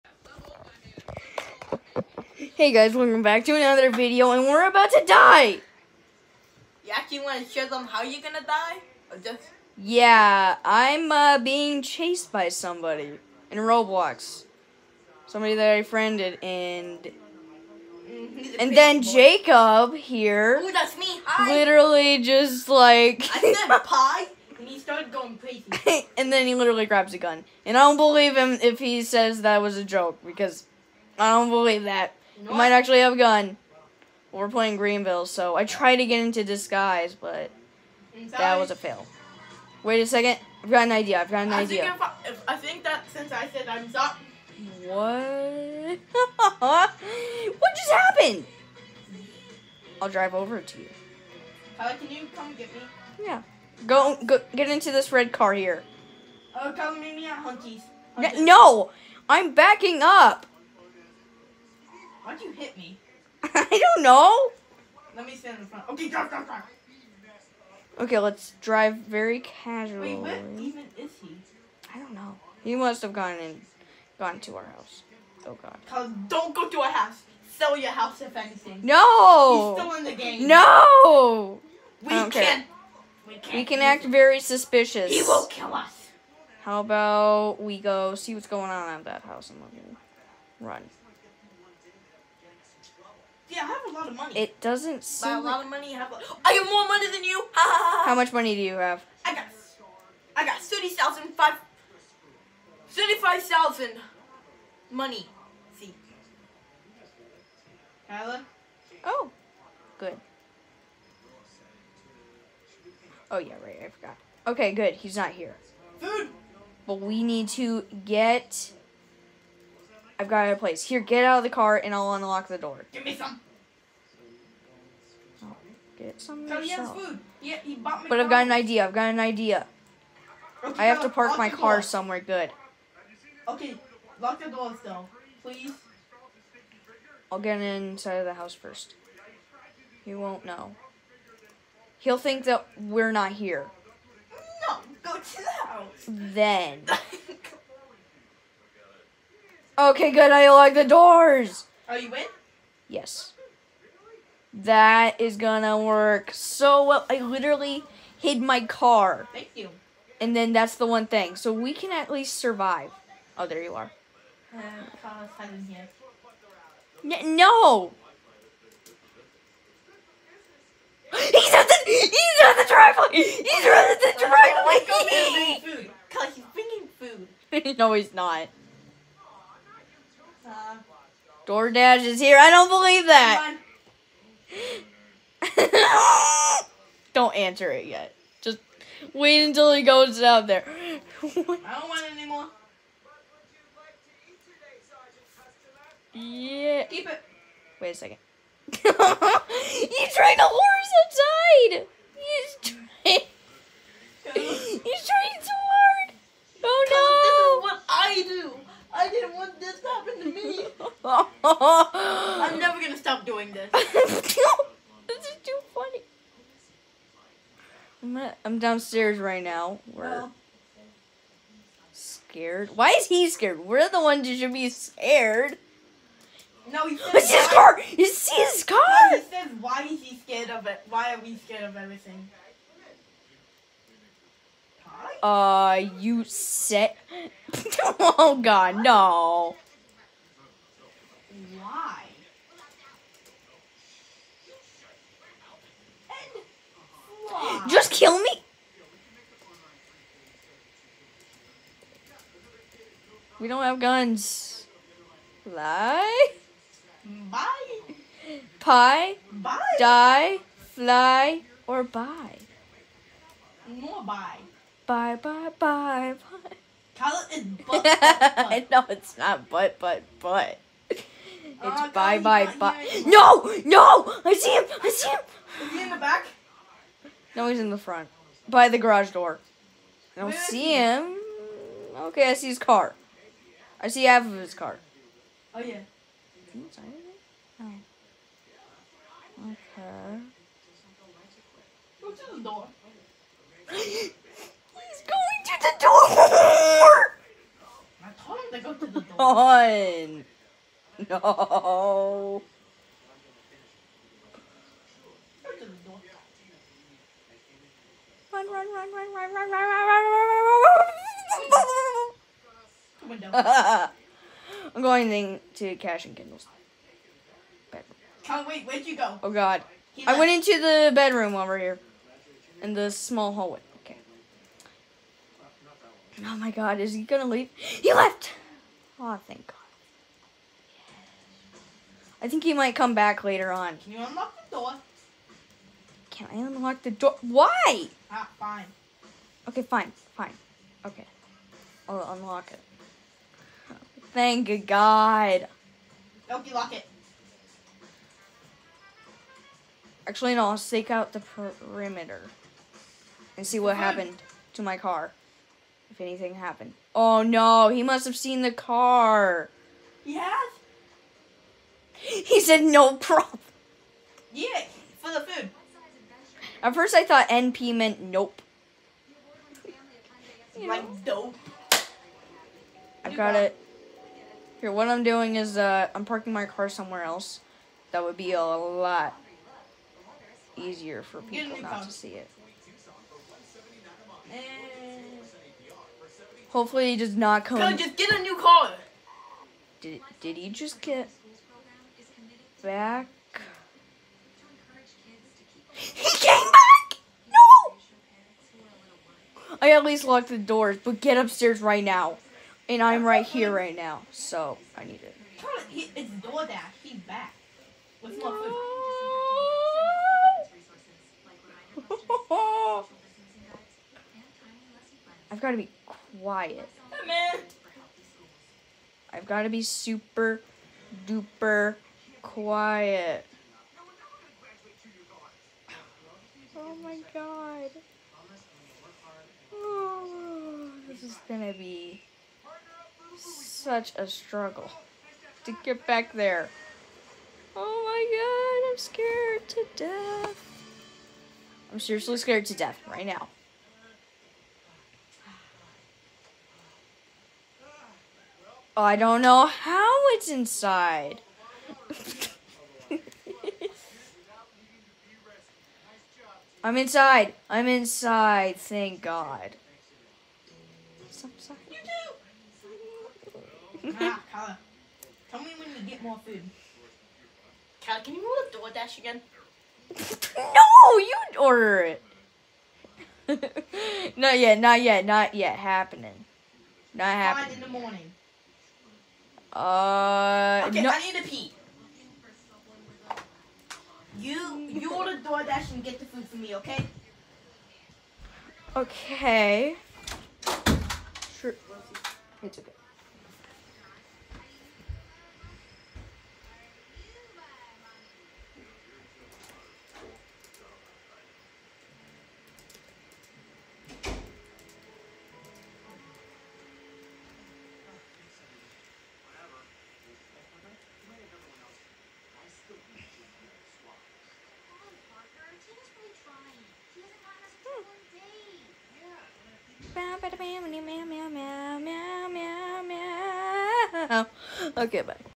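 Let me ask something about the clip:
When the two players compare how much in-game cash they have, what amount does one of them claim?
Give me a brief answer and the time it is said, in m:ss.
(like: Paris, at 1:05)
35,000, at 1:42.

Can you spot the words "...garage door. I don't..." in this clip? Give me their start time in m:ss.
4:38.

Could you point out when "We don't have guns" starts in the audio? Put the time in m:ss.
4:13.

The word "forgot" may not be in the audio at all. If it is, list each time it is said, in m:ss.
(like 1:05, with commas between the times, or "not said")
1:53.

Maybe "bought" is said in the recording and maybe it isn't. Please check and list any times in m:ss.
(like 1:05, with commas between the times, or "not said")
2:07.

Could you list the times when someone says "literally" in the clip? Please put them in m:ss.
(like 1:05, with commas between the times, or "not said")
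0:21, 0:26, 2:37.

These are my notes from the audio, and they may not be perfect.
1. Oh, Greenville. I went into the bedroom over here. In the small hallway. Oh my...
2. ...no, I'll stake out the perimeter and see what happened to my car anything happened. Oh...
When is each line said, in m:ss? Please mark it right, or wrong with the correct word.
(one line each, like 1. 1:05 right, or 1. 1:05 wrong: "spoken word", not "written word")
1. 5:19 wrong: "God", not "Greenville"
2. 5:50 right.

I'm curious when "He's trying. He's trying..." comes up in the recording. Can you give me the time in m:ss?
3:22.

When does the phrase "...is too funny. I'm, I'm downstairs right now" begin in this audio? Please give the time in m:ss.
3:34.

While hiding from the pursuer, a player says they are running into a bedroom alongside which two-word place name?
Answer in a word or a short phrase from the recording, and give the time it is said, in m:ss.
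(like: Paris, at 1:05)
Cash and kindles, at 5:15.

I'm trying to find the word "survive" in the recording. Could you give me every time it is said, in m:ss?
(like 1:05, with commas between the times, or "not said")
2:42.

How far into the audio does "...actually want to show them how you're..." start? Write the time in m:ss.
0:06.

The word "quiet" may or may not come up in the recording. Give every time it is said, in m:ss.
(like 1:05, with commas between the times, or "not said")
6:56, 7:02.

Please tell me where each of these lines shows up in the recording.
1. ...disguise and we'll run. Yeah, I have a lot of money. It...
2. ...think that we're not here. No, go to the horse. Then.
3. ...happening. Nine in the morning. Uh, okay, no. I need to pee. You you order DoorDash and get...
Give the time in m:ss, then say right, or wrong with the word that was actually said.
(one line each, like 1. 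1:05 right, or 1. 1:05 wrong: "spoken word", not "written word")
1. 1:29 wrong: "house", not "disguise"
2. 2:22 wrong: "house", not "horse"
3. 7:57 right.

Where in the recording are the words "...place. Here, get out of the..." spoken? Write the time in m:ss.
2:00.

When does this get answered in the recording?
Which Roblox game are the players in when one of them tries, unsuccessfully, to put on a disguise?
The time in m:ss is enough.
0:34.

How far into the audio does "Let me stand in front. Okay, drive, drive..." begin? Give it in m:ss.
1:05.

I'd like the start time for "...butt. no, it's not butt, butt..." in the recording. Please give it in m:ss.
4:28.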